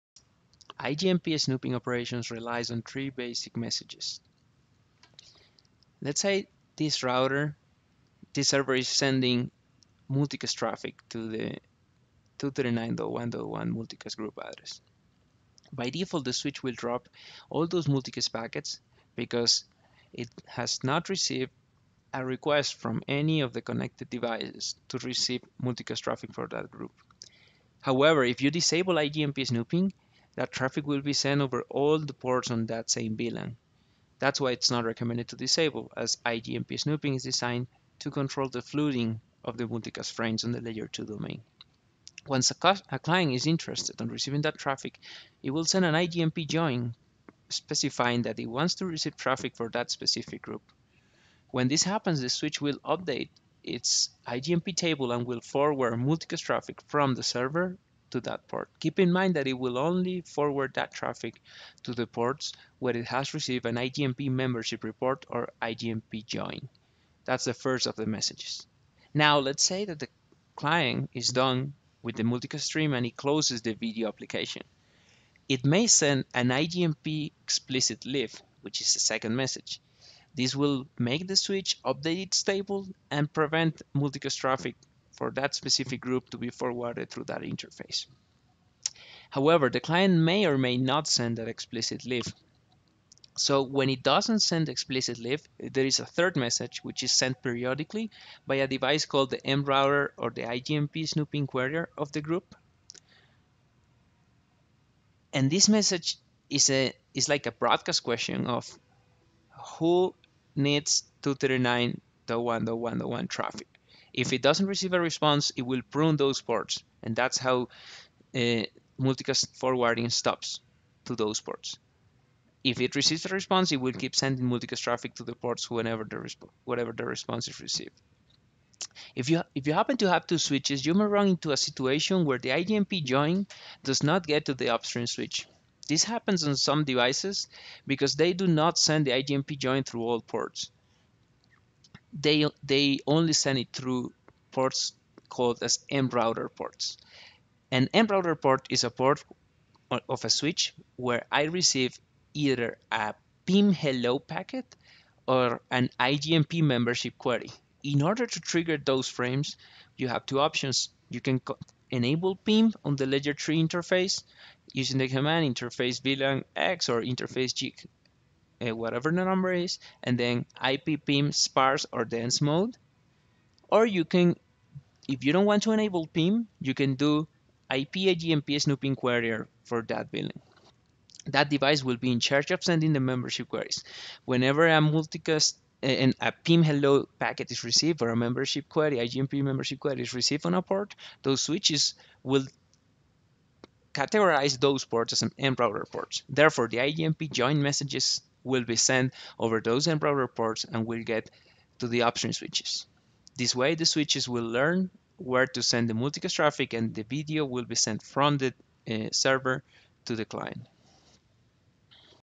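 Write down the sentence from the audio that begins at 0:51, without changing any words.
When this happens, the switch will update its IGMP table and will forward multicast traffic from the server to that port.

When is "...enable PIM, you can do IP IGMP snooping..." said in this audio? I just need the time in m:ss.
2:55.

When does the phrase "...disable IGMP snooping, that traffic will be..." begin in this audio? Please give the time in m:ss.
0:28.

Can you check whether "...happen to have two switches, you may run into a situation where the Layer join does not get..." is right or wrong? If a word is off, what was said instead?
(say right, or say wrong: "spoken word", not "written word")
wrong: "IGMP", not "Layer".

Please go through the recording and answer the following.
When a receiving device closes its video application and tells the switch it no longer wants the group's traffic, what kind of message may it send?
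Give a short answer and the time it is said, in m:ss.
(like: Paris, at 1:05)
IGMP explicit leave, at 1:16.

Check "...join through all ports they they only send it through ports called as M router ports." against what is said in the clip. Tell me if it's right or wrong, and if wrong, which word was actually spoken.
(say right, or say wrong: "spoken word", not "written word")
right.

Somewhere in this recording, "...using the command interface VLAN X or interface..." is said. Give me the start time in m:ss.
2:44.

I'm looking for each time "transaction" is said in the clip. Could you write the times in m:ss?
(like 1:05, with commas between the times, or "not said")
not said.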